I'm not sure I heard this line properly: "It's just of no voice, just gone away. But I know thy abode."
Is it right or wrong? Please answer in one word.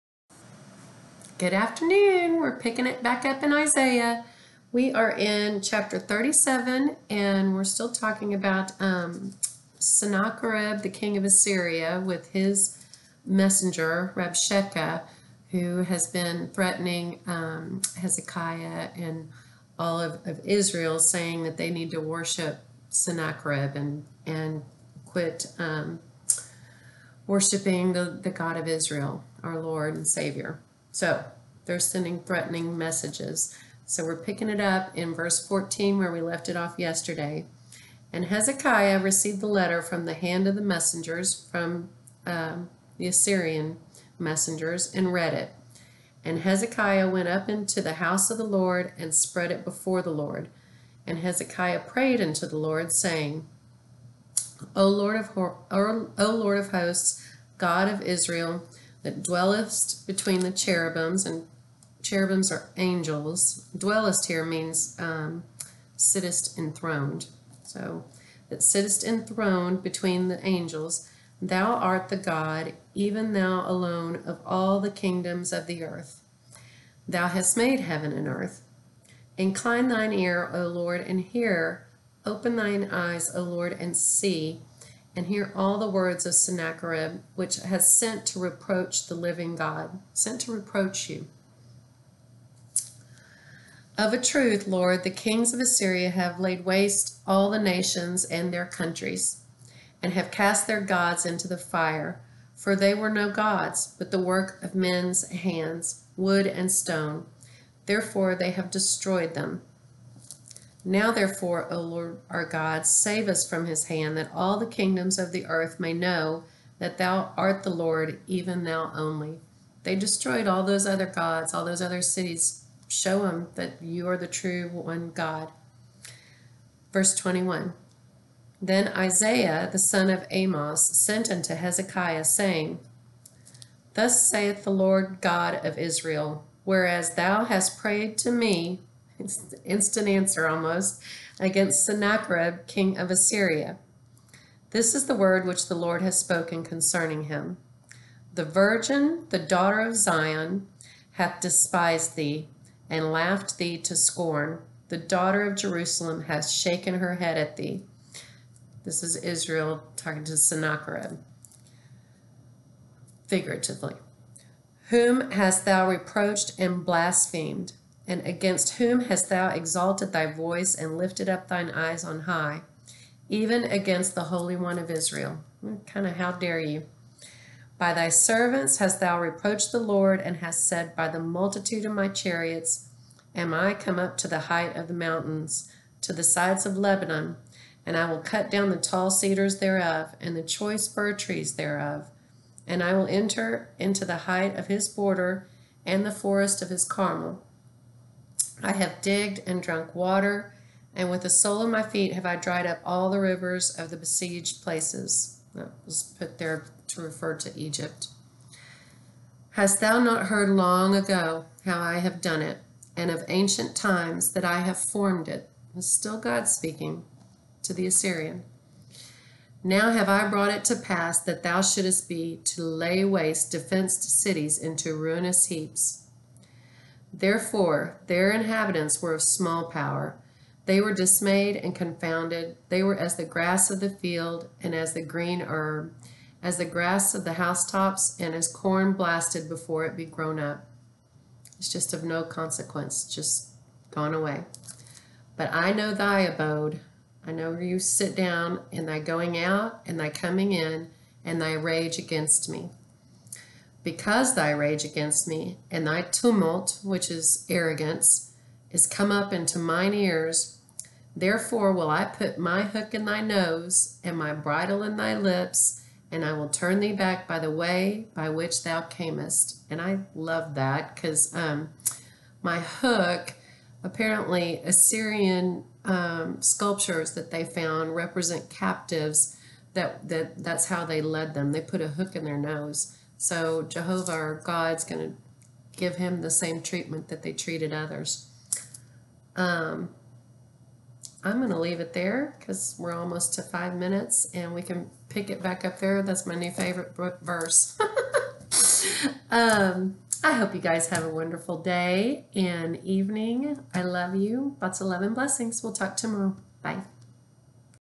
wrong.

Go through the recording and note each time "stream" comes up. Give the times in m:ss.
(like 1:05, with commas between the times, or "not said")
not said.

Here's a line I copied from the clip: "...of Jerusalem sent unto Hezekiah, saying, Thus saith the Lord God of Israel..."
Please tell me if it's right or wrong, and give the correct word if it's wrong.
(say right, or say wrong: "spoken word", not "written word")
wrong: "Amos", not "Jerusalem".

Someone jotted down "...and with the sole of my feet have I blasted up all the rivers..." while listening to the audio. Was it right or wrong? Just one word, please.
wrong.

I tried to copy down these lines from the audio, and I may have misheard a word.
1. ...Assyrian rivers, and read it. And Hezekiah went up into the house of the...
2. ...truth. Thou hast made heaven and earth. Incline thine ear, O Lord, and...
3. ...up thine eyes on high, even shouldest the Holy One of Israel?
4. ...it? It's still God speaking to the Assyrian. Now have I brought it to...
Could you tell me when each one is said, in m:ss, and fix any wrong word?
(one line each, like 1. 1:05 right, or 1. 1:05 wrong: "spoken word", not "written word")
1. 0:43 wrong: "messengers", not "rivers"
2. 1:15 wrong: "earth", not "truth"
3. 2:51 wrong: "against", not "shouldest"
4. 3:35 right.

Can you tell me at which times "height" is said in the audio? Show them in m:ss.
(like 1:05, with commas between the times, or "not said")
3:04, 3:14.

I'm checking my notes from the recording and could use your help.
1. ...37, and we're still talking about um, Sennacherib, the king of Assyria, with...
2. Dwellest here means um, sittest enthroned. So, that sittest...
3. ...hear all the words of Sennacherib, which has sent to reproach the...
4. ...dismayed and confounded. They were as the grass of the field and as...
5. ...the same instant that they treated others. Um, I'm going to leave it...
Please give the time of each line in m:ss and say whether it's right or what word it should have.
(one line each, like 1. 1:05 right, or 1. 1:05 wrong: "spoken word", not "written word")
1. 0:05 right
2. 1:03 right
3. 1:25 right
4. 3:50 right
5. 4:46 wrong: "treatment", not "instant".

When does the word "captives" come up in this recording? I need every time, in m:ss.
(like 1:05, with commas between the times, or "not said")
4:38.